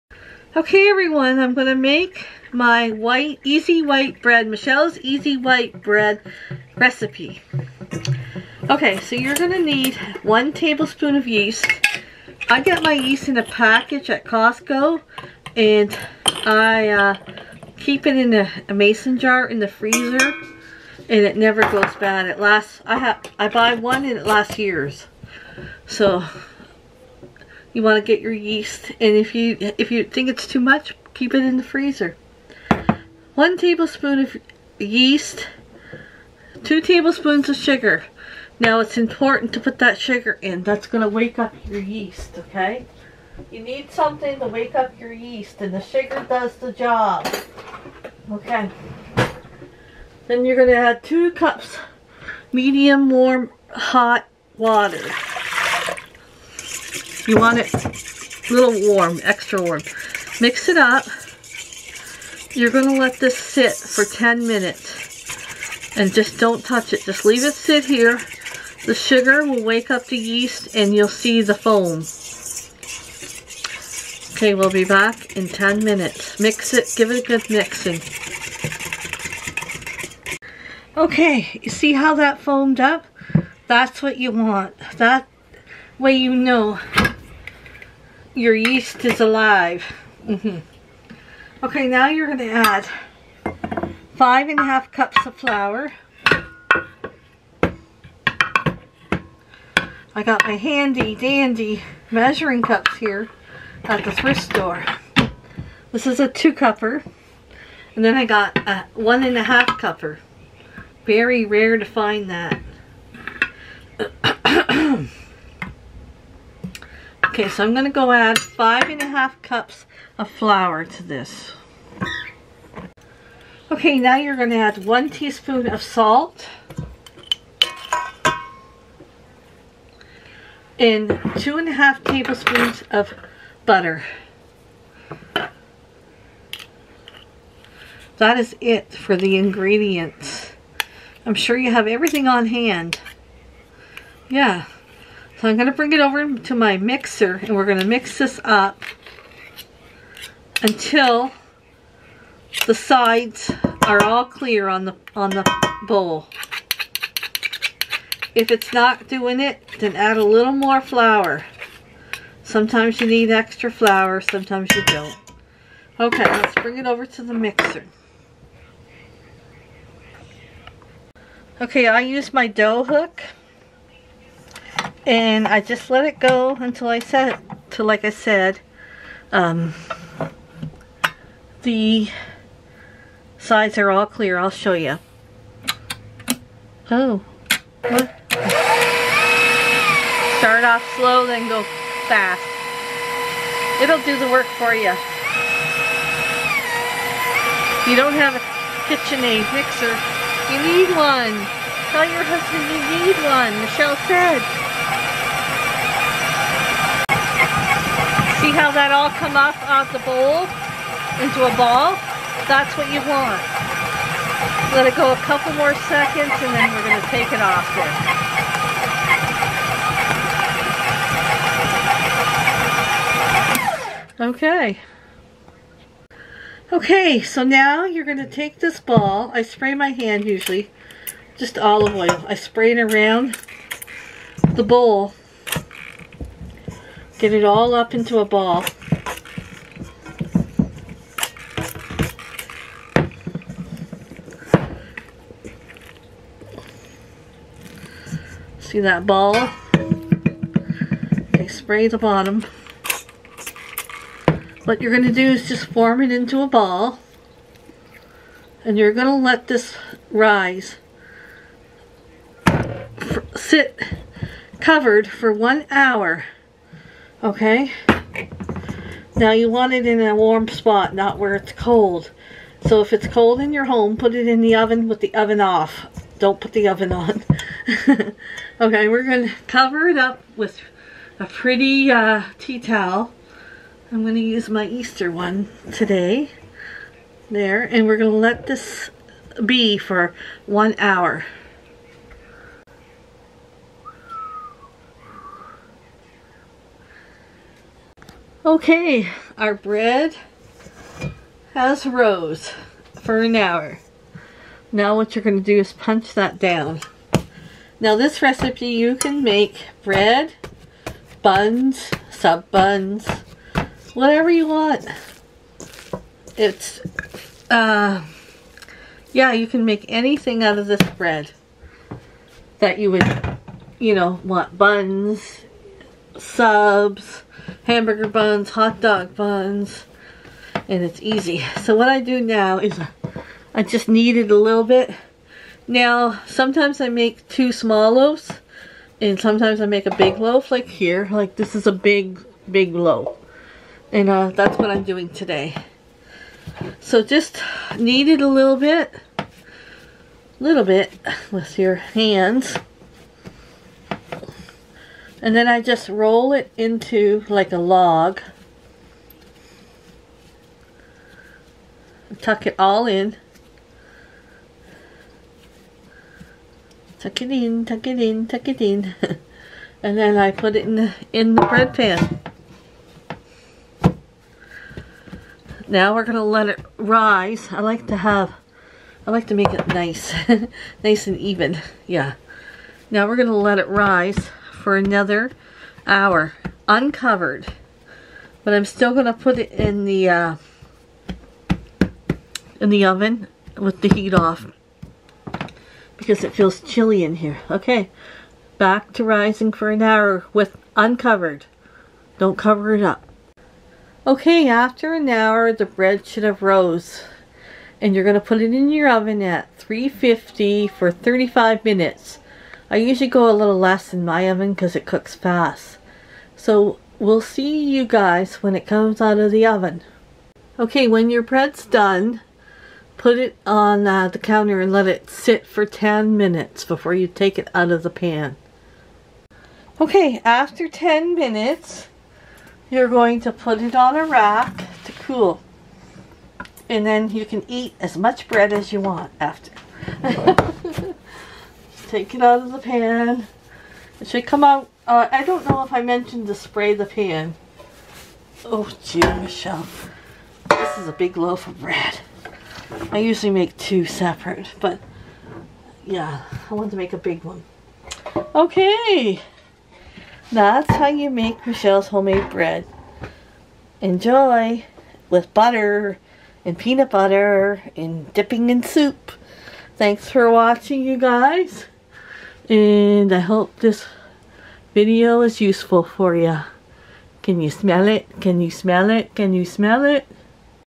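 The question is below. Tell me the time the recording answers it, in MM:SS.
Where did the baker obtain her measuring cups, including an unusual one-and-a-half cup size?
01:44.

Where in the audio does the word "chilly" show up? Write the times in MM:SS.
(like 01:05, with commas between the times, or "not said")
06:36.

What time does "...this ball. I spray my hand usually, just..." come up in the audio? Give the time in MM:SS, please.
03:48.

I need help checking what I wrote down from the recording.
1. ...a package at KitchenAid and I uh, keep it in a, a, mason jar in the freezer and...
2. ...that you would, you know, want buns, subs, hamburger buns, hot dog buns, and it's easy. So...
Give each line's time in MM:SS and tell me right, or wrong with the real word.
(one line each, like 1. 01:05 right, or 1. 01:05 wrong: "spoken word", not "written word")
1. 00:13 wrong: "Costco", not "KitchenAid"
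2. 05:22 right.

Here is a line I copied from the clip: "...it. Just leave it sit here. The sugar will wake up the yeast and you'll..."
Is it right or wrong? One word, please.
right.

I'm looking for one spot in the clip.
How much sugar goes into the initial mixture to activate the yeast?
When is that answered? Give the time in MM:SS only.
00:36.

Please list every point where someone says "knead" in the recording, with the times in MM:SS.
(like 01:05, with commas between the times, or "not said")
05:33, 05:47.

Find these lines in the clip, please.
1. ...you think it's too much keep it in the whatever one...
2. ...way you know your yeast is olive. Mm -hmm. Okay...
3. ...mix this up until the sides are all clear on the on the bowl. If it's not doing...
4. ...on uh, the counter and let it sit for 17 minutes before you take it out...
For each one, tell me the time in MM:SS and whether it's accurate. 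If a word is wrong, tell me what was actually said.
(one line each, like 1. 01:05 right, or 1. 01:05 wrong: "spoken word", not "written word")
1. 00:29 wrong: "freezer", not "whatever"
2. 01:25 wrong: "alive", not "olive"
3. 02:27 right
4. 07:03 wrong: "10", not "17".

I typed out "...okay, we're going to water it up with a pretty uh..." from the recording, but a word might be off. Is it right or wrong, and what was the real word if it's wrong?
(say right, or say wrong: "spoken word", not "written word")
wrong: "cover", not "water".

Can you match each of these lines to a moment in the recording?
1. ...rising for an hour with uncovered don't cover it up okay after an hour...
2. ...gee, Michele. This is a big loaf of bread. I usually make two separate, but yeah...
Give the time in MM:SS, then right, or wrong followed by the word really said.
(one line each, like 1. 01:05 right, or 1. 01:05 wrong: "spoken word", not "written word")
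1. 06:39 right
2. 07:28 right.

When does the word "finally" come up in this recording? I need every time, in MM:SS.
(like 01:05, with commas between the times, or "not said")
not said.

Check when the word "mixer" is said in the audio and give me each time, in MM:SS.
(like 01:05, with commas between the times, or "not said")
02:26, 02:47, 03:19.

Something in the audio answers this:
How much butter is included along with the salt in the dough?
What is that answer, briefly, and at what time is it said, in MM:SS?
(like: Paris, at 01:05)
2 and a half tablespoons, at 02:11.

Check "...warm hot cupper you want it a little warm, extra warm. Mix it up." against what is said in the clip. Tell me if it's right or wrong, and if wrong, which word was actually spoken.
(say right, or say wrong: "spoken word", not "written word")
wrong: "water", not "cupper".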